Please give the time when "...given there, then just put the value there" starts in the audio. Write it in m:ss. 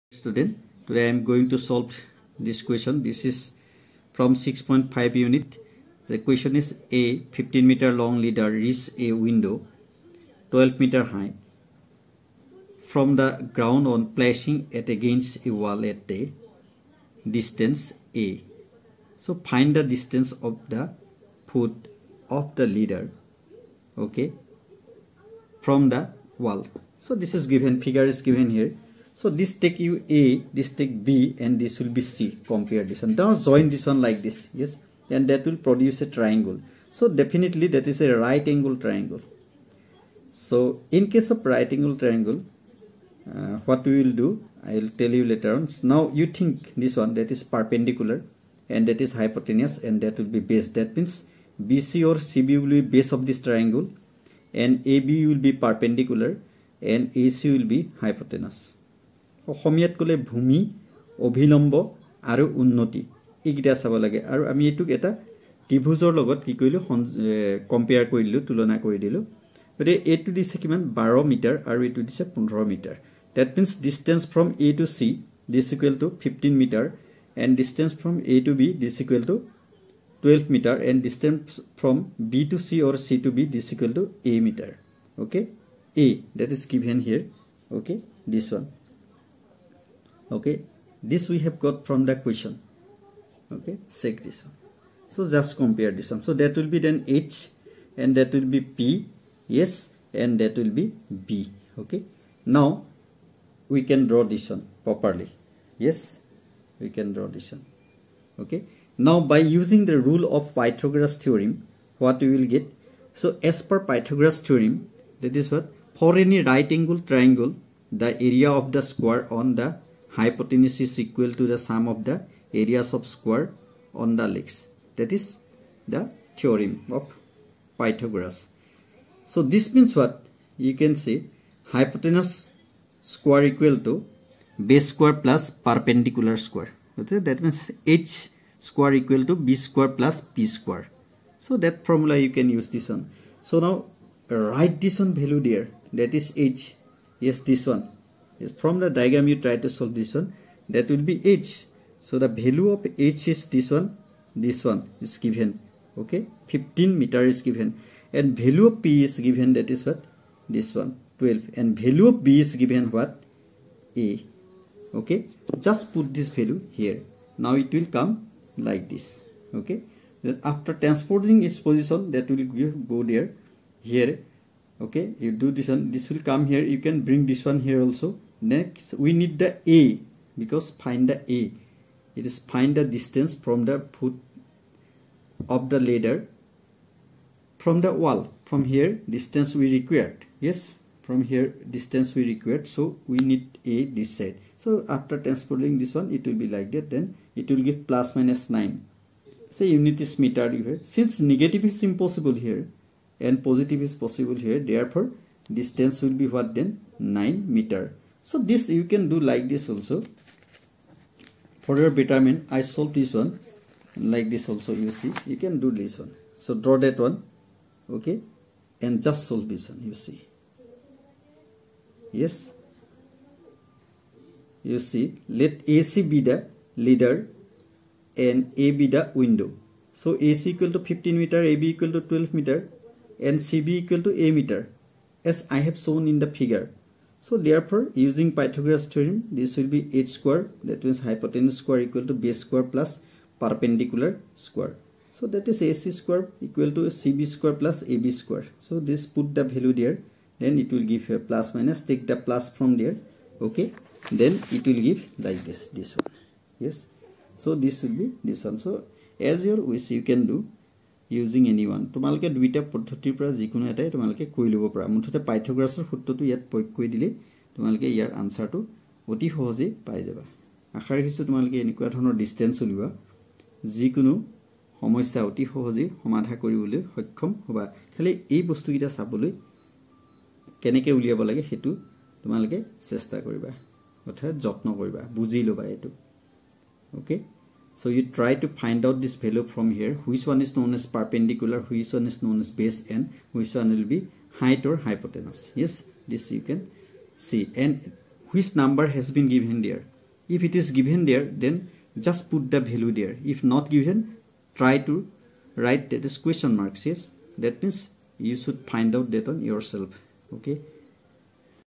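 5:00.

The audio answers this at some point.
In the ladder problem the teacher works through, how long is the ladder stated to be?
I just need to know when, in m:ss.
0:06.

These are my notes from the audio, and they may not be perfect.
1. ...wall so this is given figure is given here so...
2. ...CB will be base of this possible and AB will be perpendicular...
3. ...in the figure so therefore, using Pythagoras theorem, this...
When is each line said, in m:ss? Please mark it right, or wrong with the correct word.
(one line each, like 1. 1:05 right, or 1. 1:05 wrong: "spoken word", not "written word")
1. 0:26 right
2. 0:52 wrong: "triangle", not "possible"
3. 3:56 right.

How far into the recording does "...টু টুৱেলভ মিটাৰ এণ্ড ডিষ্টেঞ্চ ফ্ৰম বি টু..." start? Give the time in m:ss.
1:19.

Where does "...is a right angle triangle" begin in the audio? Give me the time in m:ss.
0:37.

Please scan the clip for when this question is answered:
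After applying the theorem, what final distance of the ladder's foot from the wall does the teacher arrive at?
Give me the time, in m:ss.
3:26.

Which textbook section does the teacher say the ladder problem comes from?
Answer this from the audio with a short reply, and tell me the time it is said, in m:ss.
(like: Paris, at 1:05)
6.5, at 0:04.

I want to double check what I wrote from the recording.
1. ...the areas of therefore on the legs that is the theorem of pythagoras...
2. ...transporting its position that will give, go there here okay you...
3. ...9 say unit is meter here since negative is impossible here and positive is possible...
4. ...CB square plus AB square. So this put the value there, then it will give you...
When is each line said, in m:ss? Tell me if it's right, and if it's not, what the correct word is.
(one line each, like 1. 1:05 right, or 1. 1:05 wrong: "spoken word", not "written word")
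1. 2:02 wrong: "square", not "therefore"
2. 2:50 right
3. 3:18 right
4. 4:06 right.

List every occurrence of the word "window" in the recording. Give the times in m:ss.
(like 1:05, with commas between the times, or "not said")
0:09, 3:49.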